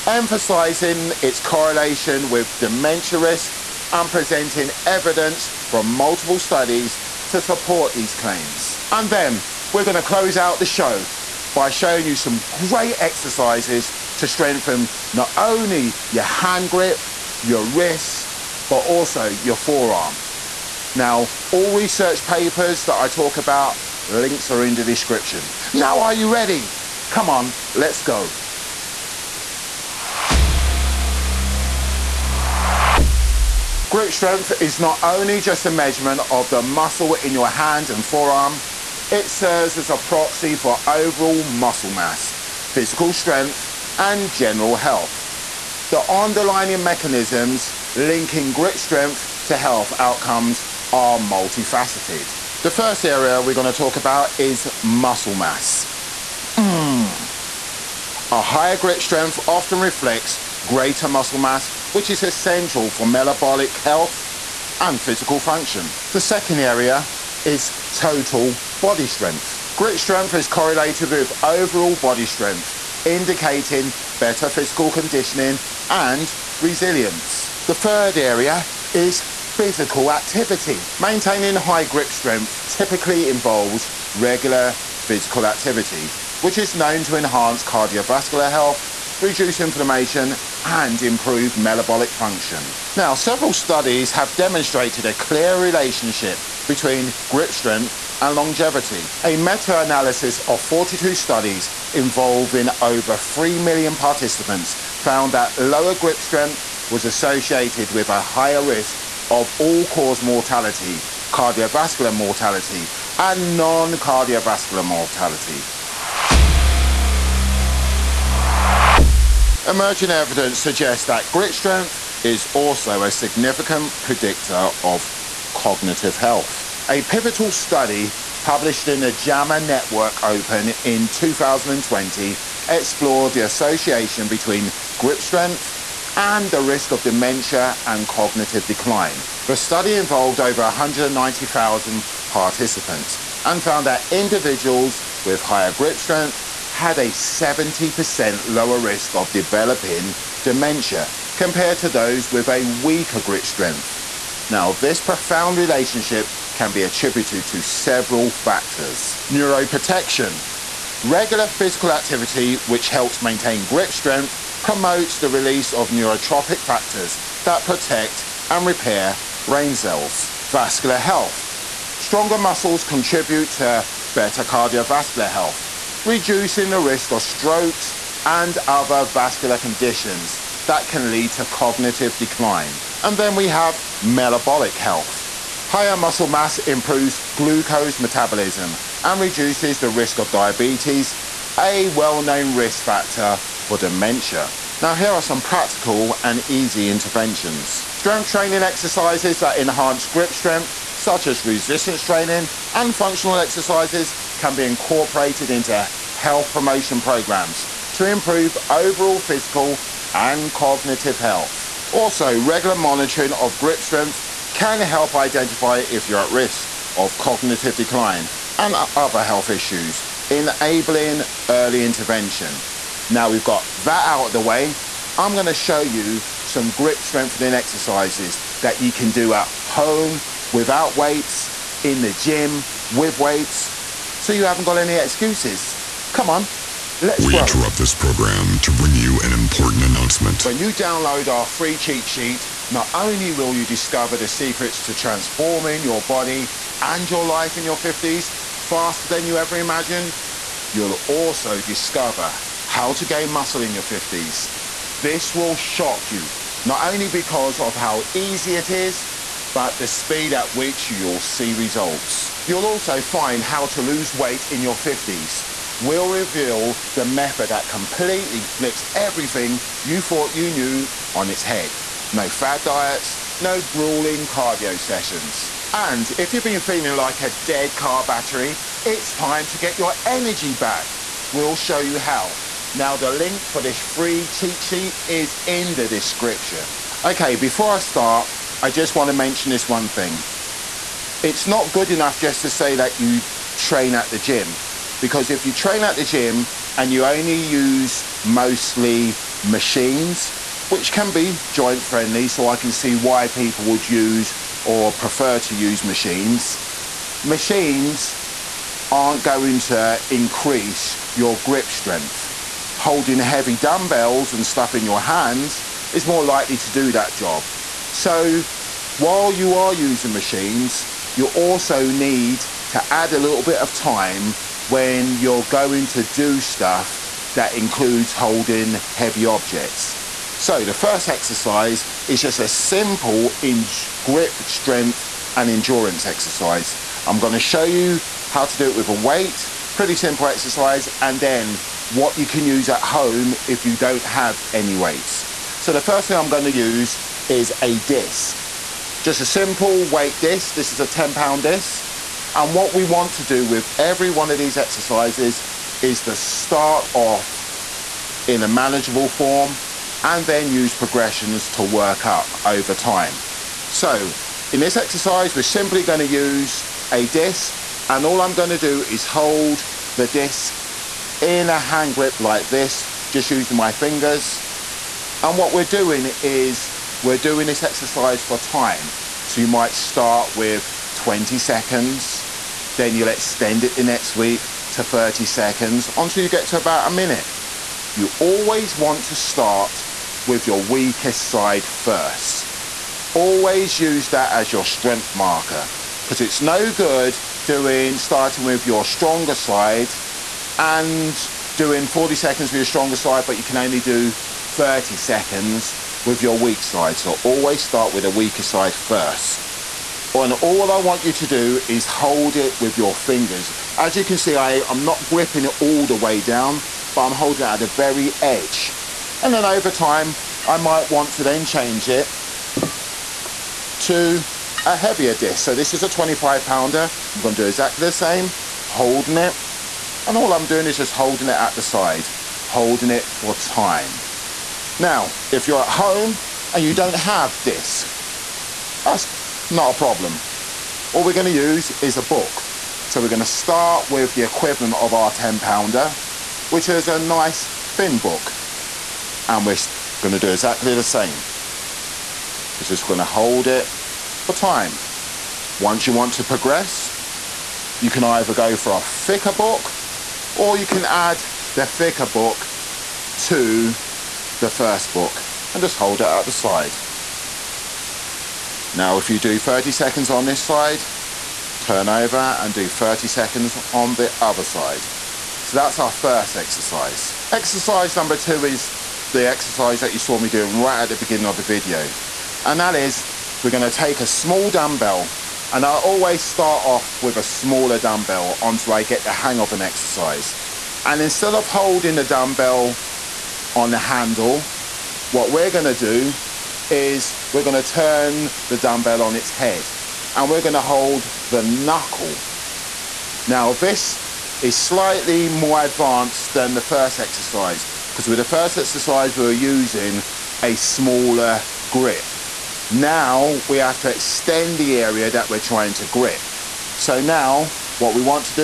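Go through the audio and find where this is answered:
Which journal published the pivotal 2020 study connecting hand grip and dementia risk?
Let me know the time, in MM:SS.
02:09.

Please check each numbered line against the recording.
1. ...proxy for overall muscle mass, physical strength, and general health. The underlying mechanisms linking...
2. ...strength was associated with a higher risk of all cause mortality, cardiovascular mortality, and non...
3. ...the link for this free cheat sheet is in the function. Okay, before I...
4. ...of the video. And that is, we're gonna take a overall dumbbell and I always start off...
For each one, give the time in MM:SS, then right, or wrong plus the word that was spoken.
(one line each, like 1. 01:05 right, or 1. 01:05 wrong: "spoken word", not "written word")
1. 00:39 right
2. 01:46 right
3. 04:42 wrong: "description", not "function"
4. 08:01 wrong: "small", not "overall".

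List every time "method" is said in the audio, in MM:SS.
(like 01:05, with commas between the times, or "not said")
04:27.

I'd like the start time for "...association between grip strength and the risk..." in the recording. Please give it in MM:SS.
02:13.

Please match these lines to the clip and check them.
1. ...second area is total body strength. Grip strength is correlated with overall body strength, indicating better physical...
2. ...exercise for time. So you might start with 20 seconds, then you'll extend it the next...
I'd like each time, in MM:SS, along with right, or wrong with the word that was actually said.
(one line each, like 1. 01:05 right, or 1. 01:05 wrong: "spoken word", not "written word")
1. 01:06 right
2. 06:17 right.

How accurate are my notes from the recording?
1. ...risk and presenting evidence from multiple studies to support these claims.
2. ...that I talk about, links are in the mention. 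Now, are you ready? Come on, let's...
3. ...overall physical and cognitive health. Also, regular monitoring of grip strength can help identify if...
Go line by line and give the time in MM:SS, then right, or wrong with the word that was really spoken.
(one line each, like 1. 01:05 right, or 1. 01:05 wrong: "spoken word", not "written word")
1. 00:03 right
2. 00:22 wrong: "description", not "mention"
3. 03:28 right.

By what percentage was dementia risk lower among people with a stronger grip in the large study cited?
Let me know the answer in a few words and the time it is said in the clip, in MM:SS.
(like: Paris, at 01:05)
70%, at 02:27.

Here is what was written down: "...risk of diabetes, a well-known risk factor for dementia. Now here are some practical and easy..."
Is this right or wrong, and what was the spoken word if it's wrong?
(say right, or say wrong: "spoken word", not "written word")
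right.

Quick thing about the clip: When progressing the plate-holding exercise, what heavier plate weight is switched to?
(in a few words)
25 pounds.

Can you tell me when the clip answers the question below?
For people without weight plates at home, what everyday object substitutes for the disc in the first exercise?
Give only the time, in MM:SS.
07:21.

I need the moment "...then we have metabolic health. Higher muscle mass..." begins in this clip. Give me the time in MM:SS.
03:03.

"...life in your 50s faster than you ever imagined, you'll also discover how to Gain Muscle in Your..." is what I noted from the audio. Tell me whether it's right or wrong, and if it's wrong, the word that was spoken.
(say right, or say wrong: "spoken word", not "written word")
right.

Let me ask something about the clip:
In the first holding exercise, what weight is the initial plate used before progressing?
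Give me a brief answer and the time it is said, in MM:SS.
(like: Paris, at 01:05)
10 pounds, at 05:50.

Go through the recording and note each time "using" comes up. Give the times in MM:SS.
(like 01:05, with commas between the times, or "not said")
05:19, 06:13, 08:29.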